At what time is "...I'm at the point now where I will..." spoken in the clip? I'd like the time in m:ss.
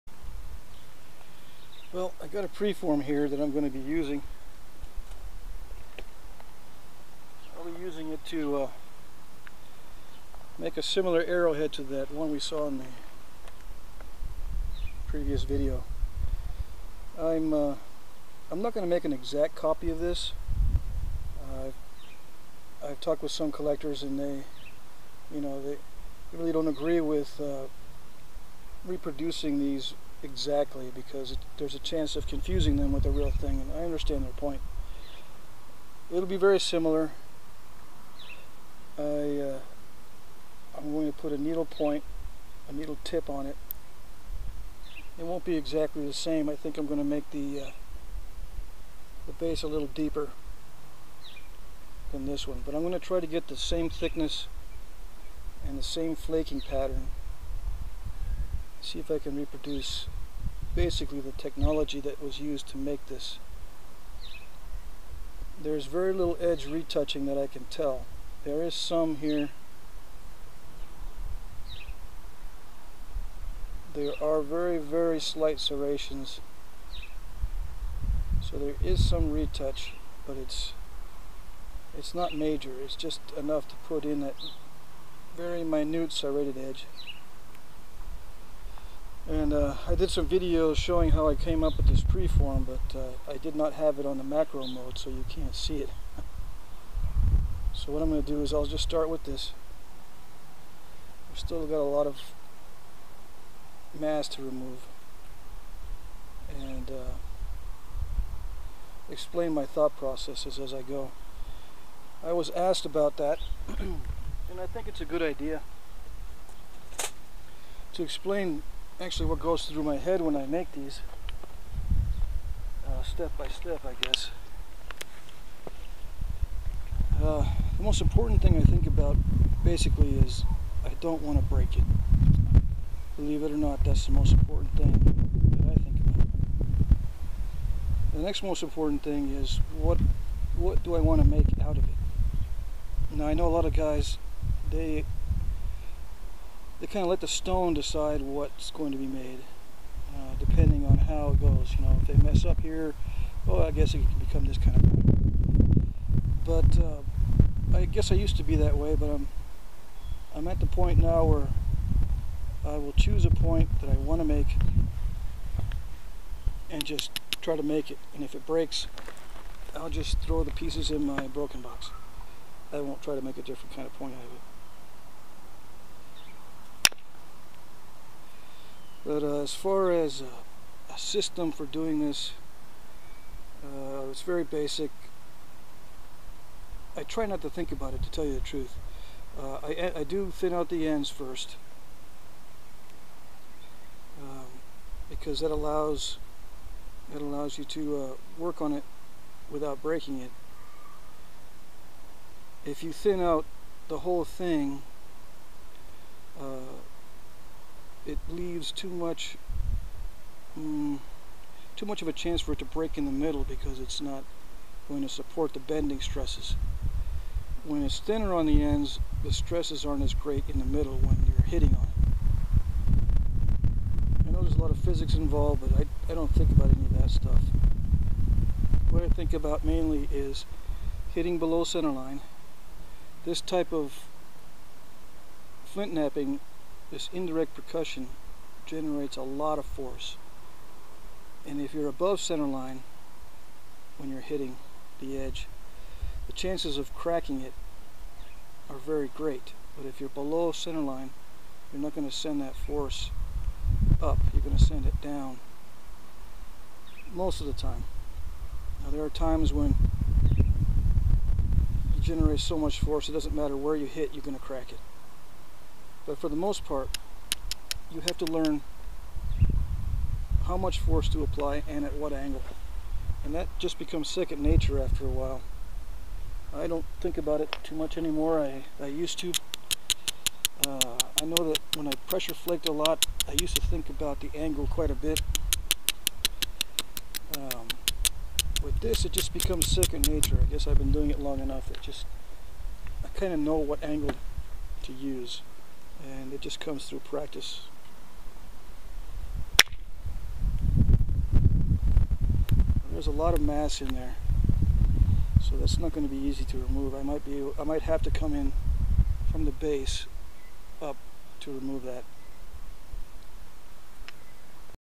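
2:40.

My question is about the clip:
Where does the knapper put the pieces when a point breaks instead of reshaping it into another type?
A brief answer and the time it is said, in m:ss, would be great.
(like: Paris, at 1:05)
Broken box, at 2:51.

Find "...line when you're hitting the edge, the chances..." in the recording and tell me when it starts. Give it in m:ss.
4:02.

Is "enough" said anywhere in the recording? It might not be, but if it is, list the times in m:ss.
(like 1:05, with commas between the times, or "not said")
1:23, 4:51.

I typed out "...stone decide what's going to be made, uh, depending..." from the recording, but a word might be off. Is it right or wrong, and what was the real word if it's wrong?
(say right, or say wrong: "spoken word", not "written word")
right.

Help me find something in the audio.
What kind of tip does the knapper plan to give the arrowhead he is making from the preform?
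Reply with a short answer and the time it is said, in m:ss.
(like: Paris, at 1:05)
Needle tip, at 0:42.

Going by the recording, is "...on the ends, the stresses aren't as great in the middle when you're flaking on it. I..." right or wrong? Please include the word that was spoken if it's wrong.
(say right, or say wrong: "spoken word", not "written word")
wrong: "hitting", not "flaking".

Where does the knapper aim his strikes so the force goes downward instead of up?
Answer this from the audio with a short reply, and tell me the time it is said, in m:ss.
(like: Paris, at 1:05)
Below centerline, at 3:51.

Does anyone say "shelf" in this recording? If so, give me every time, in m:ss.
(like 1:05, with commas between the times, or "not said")
not said.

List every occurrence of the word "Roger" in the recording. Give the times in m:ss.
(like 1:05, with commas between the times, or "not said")
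not said.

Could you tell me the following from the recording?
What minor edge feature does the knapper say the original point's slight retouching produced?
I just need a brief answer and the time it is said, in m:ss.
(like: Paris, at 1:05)
Serrations, at 1:15.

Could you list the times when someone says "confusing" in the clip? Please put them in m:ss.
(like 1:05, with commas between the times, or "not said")
0:32.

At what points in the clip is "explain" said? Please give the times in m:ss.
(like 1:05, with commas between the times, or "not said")
1:49, 1:58.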